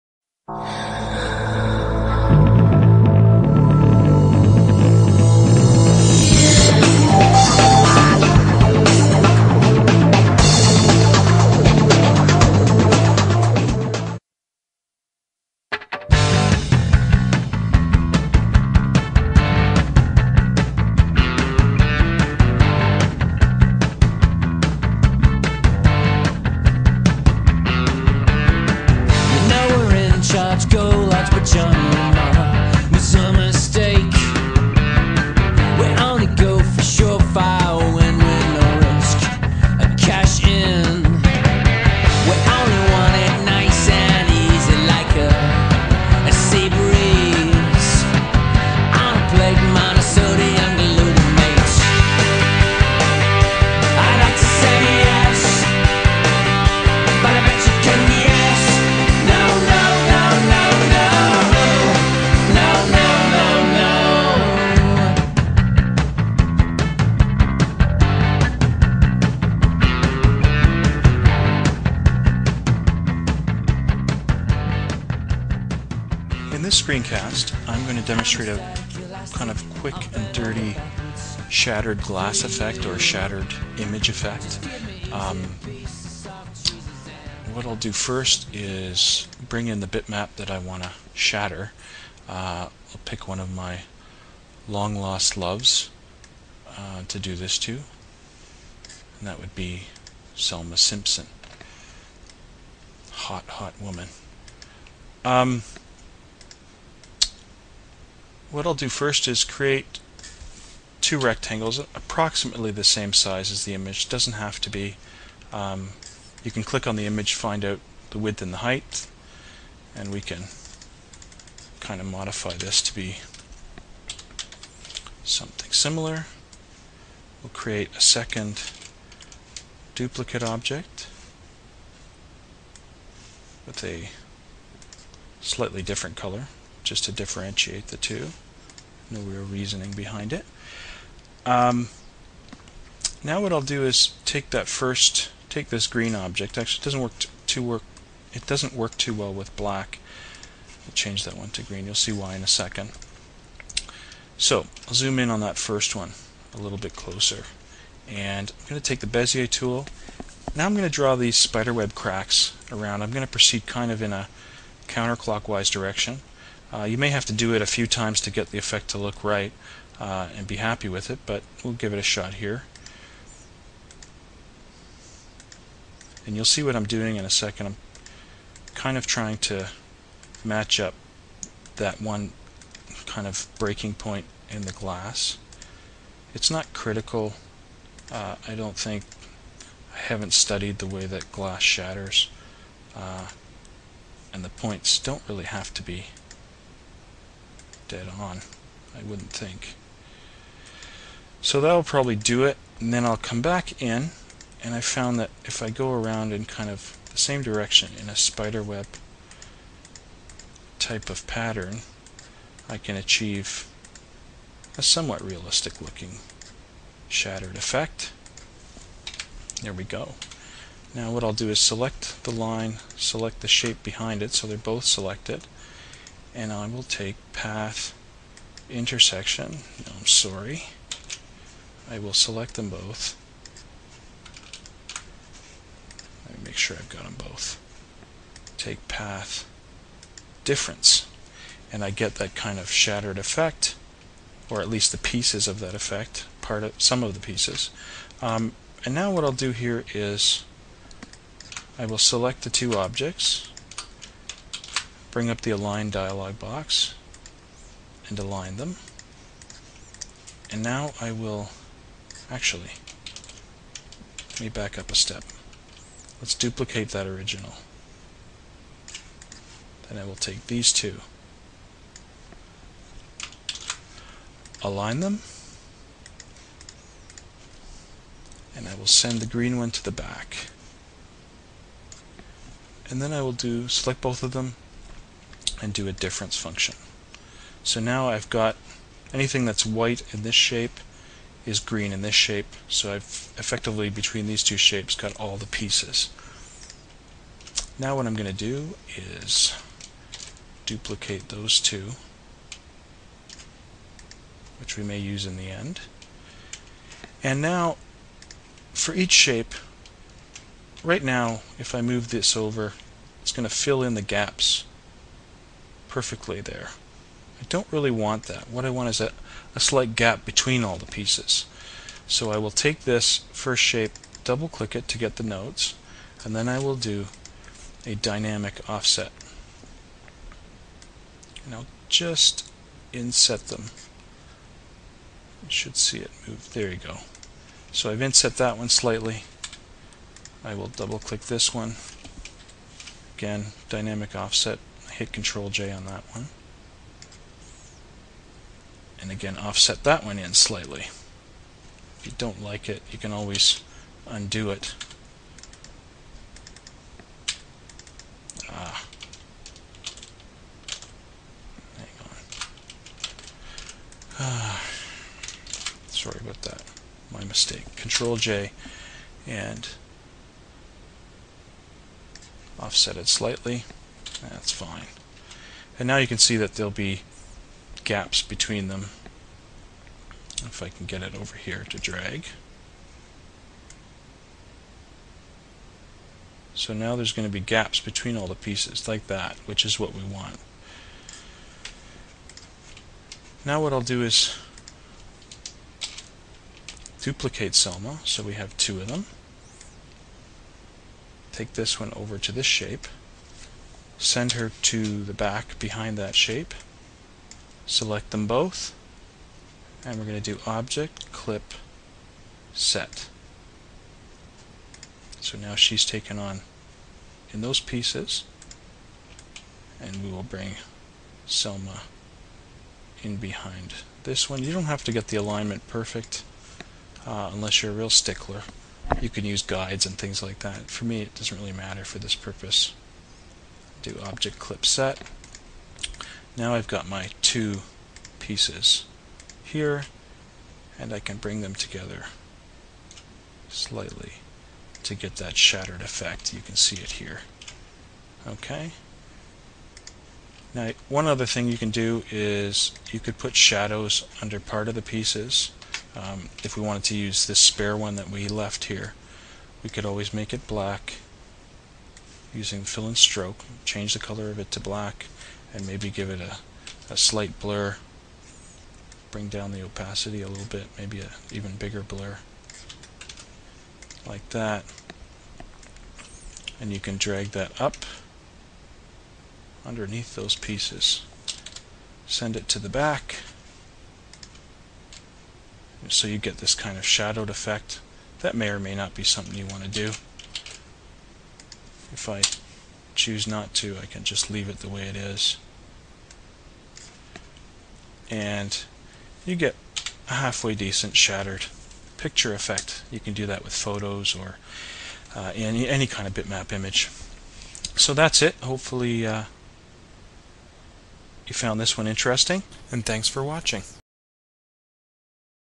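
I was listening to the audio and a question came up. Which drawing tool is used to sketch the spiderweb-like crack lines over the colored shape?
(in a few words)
Bezier tool.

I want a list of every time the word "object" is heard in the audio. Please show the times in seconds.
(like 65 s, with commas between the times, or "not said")
130 s, 146 s, 252 s, 410 s, 434 s.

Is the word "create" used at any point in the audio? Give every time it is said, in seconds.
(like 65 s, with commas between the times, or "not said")
109 s, 127 s.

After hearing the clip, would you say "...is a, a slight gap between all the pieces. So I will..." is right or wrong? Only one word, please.
right.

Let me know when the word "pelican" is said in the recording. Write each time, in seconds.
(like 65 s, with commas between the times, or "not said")
not said.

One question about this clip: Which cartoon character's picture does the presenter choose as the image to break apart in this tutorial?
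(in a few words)
Selma Simpson.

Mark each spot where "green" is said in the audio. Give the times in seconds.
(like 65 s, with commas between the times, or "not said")
145 s, 151 s, 279 s, 291 s.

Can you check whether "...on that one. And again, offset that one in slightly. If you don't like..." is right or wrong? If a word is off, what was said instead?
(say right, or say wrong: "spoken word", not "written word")
right.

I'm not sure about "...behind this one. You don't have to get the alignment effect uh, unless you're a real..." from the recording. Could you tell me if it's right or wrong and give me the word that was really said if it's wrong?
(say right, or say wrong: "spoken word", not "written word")
wrong: "perfect", not "effect".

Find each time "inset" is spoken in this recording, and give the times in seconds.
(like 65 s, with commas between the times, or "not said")
332 s, 338 s.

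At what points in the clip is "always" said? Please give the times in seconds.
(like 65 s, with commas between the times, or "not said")
353 s, 459 s.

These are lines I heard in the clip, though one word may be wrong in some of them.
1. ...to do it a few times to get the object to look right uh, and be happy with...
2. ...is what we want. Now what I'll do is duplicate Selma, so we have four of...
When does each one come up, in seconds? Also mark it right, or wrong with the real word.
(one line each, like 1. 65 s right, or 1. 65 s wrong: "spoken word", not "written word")
1. 167 s wrong: "effect", not "object"
2. 389 s wrong: "two", not "four".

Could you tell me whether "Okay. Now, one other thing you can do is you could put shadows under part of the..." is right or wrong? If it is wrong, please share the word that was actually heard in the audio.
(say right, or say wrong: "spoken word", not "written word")
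right.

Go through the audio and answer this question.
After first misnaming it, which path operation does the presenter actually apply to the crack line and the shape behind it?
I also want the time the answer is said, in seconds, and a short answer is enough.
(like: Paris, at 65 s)
path difference, at 238 s.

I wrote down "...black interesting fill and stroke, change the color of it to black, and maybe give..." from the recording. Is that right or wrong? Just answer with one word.
wrong.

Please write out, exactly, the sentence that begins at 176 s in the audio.
And you'll see what I'm doing in a second.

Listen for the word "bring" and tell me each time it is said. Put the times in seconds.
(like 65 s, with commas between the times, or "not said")
89 s, 255 s, 420 s, 441 s, 469 s.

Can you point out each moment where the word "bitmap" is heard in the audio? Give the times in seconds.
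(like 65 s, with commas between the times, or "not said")
89 s, 506 s.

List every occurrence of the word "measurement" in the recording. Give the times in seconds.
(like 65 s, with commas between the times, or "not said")
not said.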